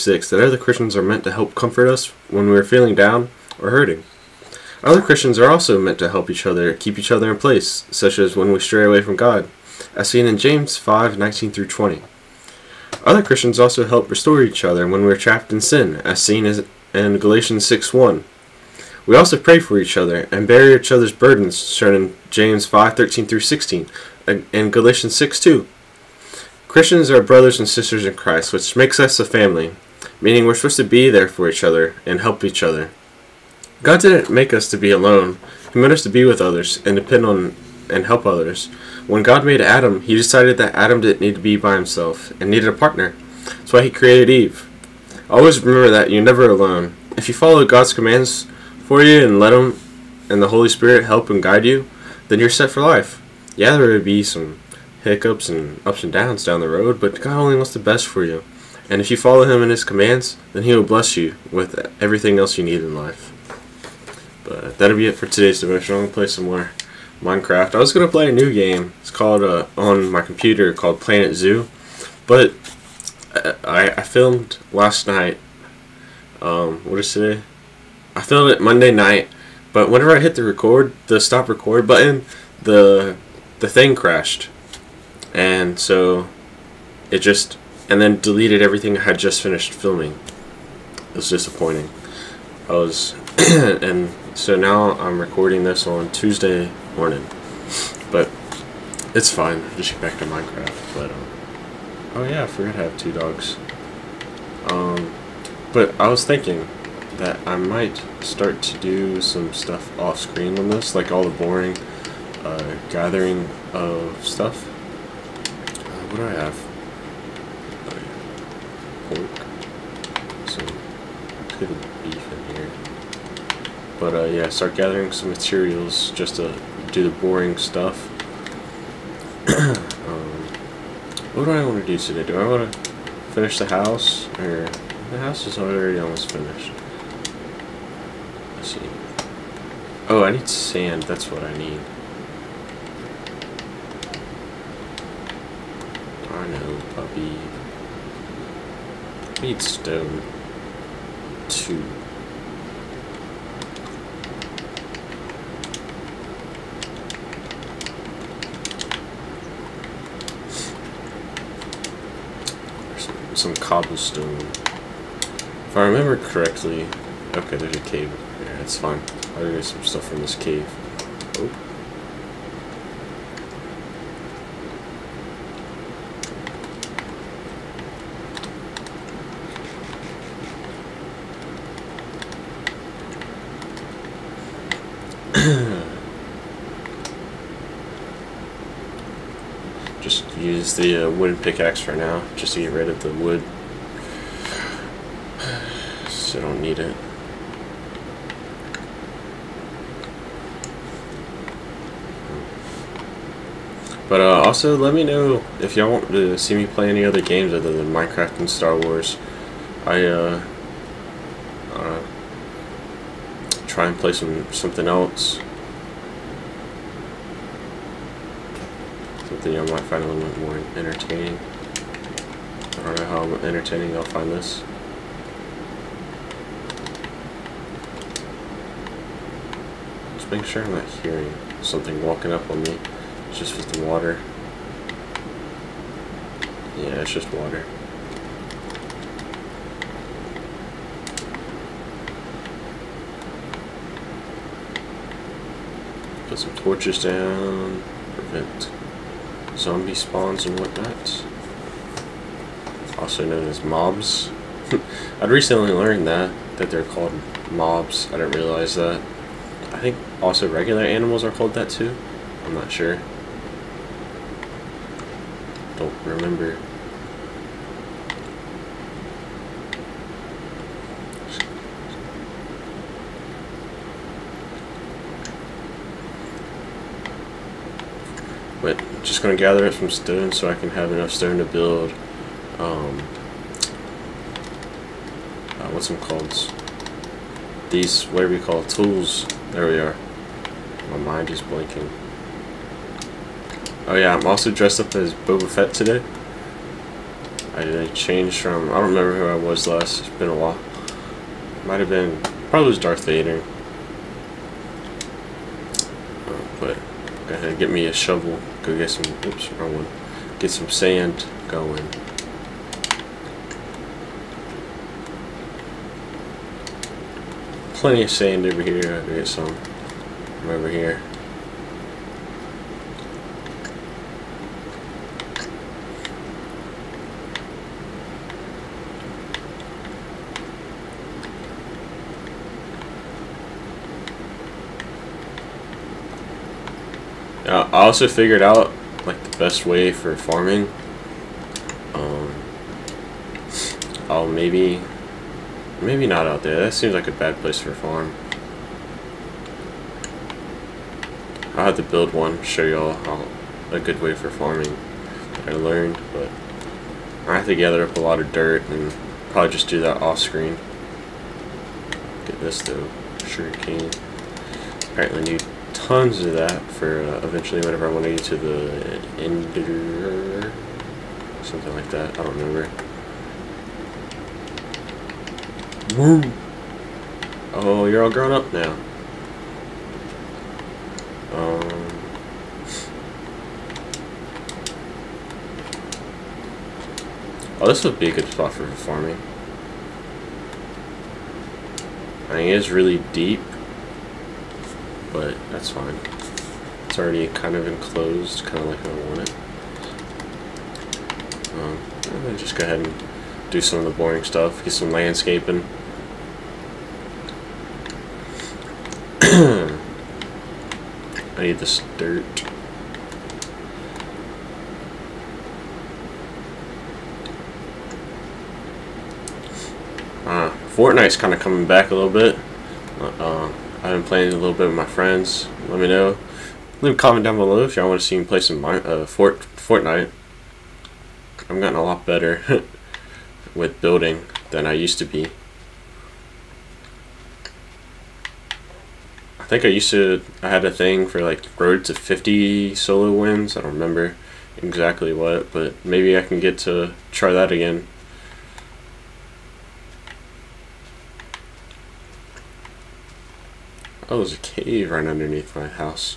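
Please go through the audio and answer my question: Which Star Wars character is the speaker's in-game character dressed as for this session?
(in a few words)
Boba Fett.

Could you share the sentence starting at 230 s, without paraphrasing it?
Just making sure I'm not hearing something walking up on me.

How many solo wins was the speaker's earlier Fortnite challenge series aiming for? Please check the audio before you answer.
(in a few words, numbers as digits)
50.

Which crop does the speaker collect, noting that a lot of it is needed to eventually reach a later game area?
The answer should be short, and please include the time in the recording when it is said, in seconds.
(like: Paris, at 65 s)
Sugar cane, at 363 s.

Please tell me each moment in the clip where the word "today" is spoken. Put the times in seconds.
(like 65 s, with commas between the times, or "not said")
65 s, 77 s, 131 s, 295 s.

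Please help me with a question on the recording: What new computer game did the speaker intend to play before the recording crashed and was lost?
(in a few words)
Planet Zoo.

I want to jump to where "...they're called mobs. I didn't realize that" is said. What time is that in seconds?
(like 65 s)
256 s.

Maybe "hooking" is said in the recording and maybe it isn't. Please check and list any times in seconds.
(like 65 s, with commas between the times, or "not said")
not said.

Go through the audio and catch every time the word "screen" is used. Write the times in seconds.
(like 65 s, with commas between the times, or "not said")
110 s, 360 s.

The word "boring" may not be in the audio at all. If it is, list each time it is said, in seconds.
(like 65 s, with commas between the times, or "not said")
111 s, 127 s, 403 s.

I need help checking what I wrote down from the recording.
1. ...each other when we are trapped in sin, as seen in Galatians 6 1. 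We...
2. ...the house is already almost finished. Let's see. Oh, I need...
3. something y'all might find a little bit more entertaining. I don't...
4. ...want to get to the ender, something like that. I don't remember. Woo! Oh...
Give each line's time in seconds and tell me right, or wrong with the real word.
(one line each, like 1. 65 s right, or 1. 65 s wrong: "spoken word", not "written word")
1. 14 s right
2. 135 s right
3. 219 s right
4. 367 s right.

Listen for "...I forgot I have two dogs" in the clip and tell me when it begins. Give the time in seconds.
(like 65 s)
102 s.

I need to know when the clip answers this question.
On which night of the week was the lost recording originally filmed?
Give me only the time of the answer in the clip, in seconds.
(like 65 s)
78 s.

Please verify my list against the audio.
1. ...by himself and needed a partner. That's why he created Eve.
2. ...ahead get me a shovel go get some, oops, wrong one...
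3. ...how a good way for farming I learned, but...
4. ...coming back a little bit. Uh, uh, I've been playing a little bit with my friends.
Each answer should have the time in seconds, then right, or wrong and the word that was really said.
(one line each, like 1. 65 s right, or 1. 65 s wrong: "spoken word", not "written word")
1. 41 s right
2. 307 s right
3. 353 s right
4. 421 s right.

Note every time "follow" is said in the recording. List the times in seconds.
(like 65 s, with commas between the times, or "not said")
47 s, 59 s.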